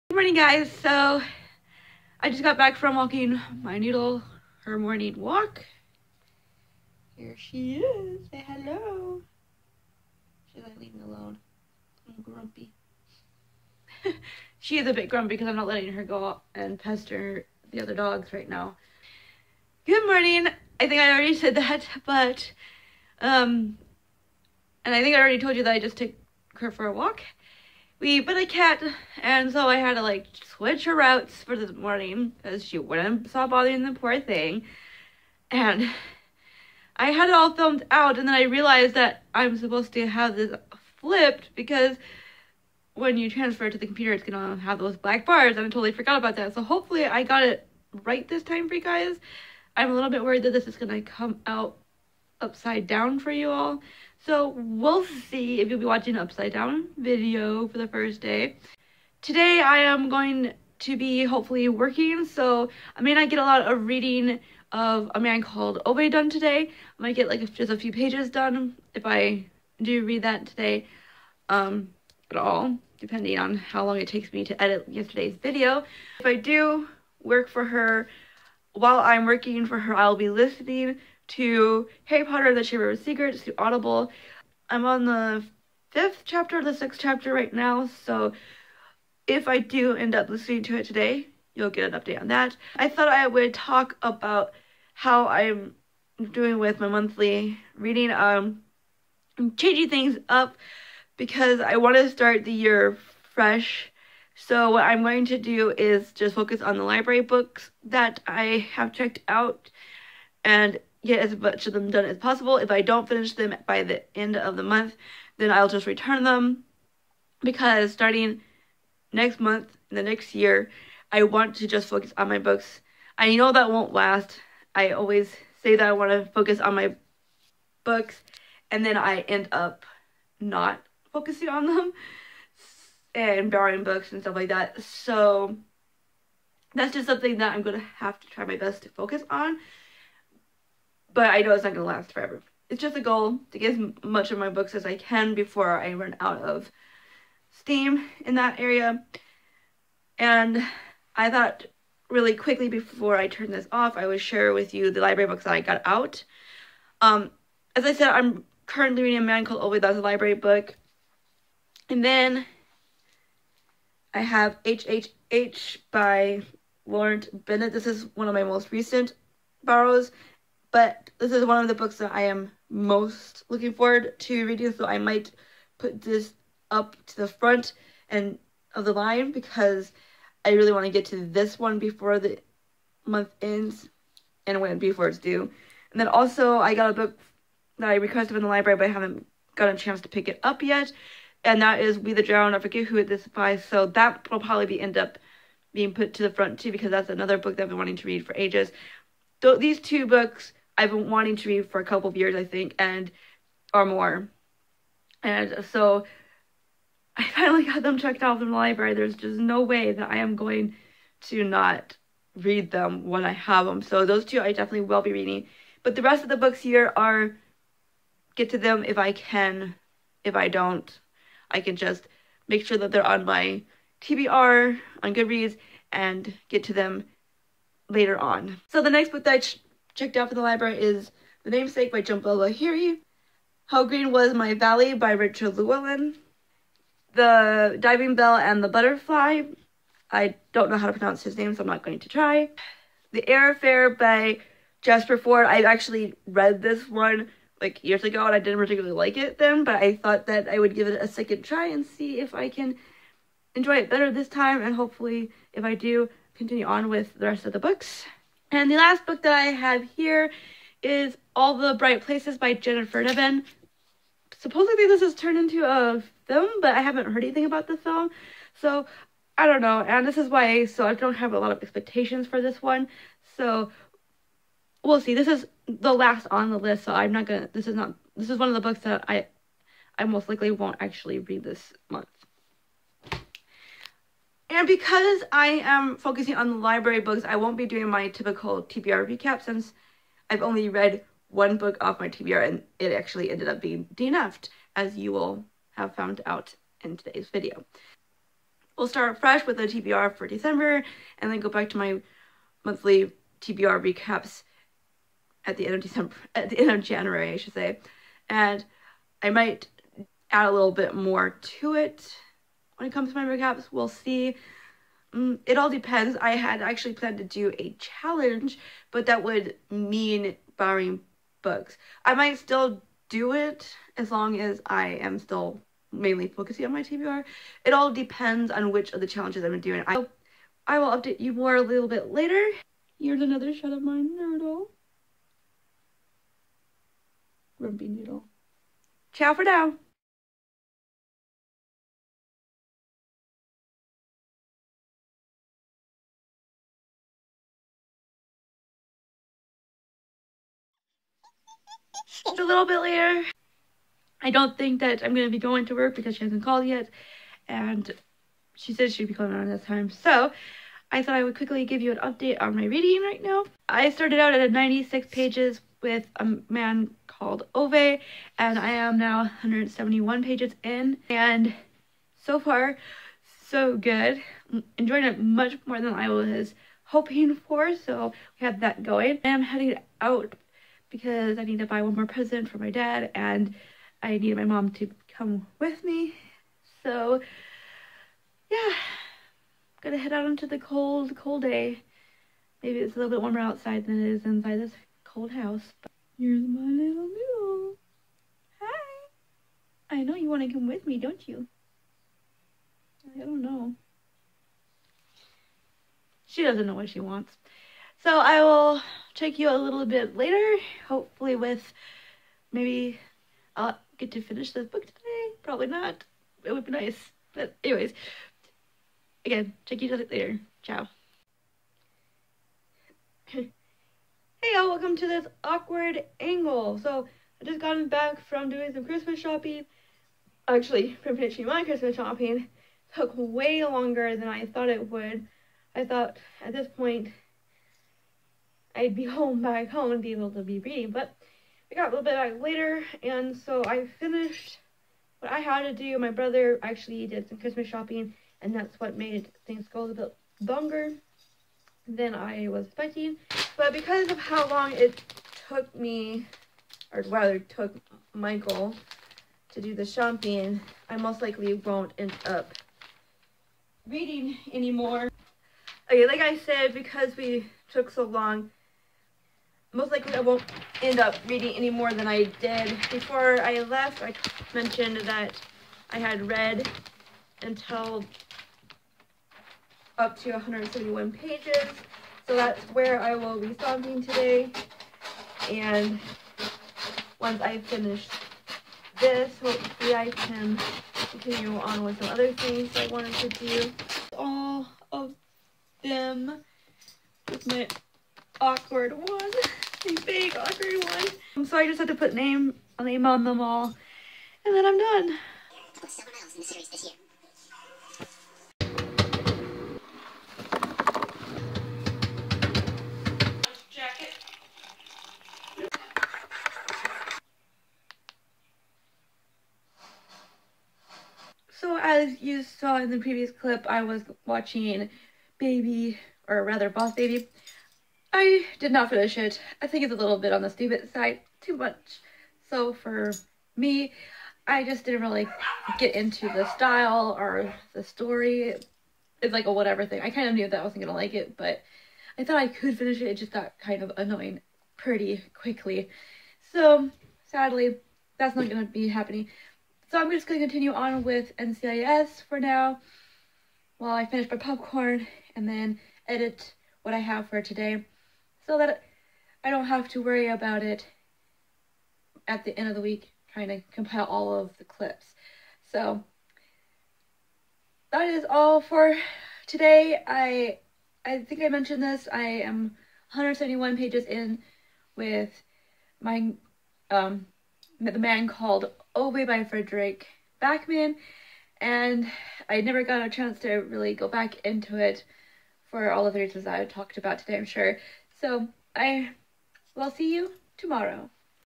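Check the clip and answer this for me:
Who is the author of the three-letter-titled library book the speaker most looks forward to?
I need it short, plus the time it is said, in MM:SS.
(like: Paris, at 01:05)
Laurent Binet, at 02:46.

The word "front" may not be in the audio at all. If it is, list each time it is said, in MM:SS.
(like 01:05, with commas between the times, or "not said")
02:57, 03:16.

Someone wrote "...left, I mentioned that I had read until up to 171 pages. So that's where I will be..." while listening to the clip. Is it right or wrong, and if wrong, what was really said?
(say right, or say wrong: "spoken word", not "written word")
right.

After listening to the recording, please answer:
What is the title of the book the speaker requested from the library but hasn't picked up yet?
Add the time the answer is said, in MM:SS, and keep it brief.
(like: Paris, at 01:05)
We the Drowned, at 03:11.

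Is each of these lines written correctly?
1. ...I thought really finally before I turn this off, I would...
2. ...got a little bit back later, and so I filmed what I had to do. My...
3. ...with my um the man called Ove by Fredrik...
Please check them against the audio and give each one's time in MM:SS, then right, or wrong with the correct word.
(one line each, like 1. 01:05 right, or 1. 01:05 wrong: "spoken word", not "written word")
1. 02:31 wrong: "quickly", not "finally"
2. 07:21 wrong: "finished", not "filmed"
3. 09:34 right.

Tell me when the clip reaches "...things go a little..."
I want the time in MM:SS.
07:29.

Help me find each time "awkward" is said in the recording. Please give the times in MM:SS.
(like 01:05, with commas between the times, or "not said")
07:05, 08:18.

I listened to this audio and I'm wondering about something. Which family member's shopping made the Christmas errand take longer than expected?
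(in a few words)
Michael.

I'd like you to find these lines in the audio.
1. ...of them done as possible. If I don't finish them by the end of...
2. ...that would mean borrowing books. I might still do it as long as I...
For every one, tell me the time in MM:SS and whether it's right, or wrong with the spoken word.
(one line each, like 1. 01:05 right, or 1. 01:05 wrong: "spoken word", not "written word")
1. 01:51 right
2. 05:19 right.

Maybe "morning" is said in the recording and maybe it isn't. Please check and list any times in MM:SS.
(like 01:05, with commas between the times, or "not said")
00:00, 00:04, 00:20, 00:31.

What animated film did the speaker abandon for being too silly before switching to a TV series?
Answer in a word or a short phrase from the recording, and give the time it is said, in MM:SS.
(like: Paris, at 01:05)
Boss Baby, at 08:46.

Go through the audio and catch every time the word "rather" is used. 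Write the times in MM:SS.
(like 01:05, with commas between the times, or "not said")
07:37, 08:46.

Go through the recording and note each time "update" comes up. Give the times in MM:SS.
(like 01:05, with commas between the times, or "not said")
01:31, 05:30, 06:01.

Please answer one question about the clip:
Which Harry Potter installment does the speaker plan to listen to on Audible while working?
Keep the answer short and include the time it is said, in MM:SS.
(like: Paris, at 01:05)
Chamber of Secrets, at 01:22.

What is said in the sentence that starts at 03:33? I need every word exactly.
So those two I definitely will be reading.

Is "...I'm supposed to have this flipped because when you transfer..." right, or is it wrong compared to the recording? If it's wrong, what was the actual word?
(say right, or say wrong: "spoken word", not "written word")
right.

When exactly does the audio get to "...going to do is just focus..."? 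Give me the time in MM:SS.
01:45.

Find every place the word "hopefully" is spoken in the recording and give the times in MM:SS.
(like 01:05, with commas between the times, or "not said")
00:46, 01:01, 04:14, 06:50, 08:09.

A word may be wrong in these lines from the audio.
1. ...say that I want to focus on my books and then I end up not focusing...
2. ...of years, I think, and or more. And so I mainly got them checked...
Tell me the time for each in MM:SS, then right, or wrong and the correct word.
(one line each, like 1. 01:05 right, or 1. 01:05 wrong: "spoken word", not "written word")
1. 02:05 right
2. 03:22 wrong: "finally", not "mainly".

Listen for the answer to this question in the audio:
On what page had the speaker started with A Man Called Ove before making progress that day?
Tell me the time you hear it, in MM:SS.
06:04.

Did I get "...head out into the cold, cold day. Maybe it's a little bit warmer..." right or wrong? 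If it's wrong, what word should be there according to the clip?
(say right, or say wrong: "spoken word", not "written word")
right.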